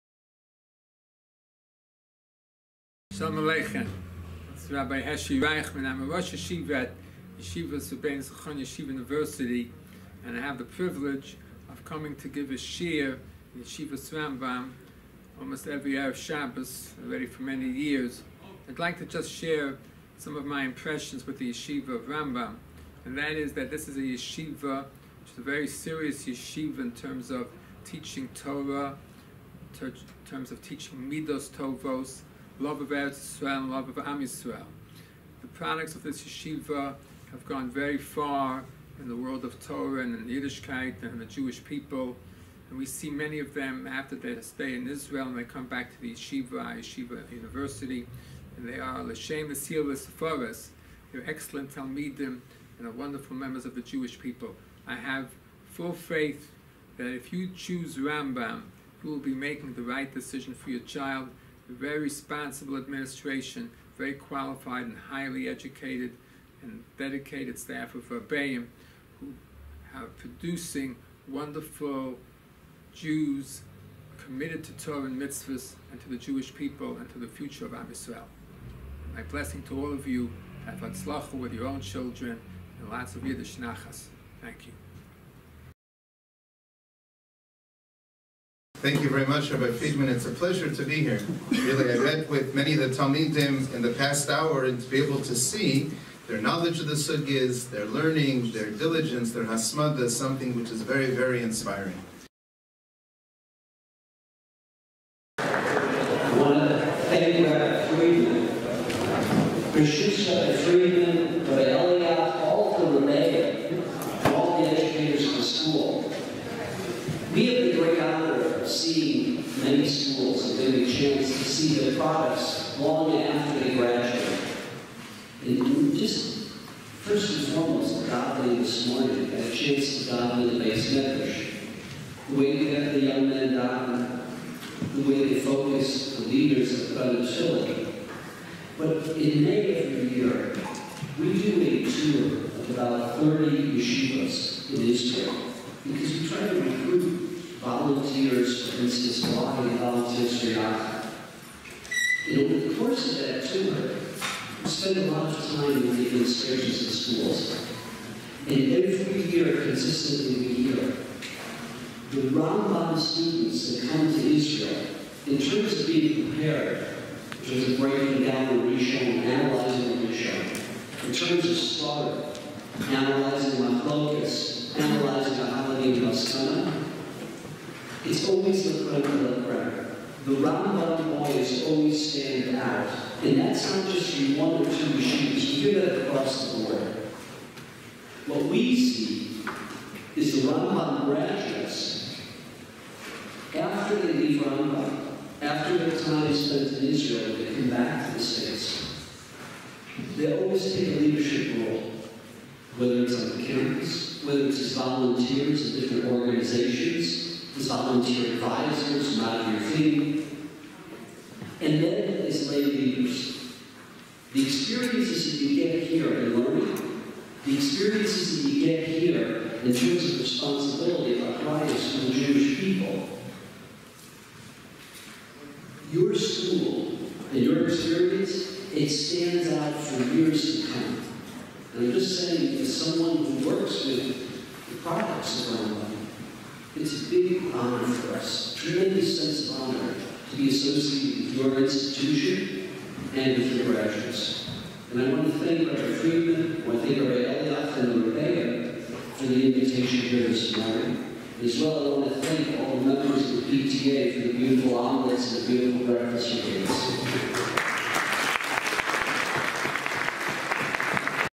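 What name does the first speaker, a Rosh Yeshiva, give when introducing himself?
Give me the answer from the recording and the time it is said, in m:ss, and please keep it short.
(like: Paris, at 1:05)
Heshi Reichman, at 0:05.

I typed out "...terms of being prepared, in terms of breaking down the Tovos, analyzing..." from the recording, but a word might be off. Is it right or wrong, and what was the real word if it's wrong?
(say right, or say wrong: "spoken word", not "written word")
wrong: "Rishon", not "Tovos".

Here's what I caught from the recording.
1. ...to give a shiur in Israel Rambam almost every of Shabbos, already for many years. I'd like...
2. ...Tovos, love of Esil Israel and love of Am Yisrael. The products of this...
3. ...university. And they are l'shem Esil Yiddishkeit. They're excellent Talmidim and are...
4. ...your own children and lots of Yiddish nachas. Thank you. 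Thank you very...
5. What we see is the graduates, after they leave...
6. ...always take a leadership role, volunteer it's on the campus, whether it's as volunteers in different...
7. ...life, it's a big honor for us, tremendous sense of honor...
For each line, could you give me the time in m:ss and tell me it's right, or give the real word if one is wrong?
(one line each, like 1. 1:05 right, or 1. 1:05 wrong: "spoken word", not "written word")
1. 0:12 wrong: "Yeshivas", not "Israel"
2. 0:31 wrong: "Eretz", not "Esil"
3. 0:47 wrong: "Sefaris", not "Yiddishkeit"
4. 1:21 right
5. 3:08 right
6. 3:20 wrong: "whether", not "volunteer"
7. 3:55 right.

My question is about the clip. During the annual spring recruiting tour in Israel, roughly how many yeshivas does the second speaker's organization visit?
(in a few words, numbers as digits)
30.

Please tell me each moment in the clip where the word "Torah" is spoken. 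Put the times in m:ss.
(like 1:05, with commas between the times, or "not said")
0:28, 0:39, 1:14.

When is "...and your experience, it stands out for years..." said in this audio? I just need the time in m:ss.
3:47.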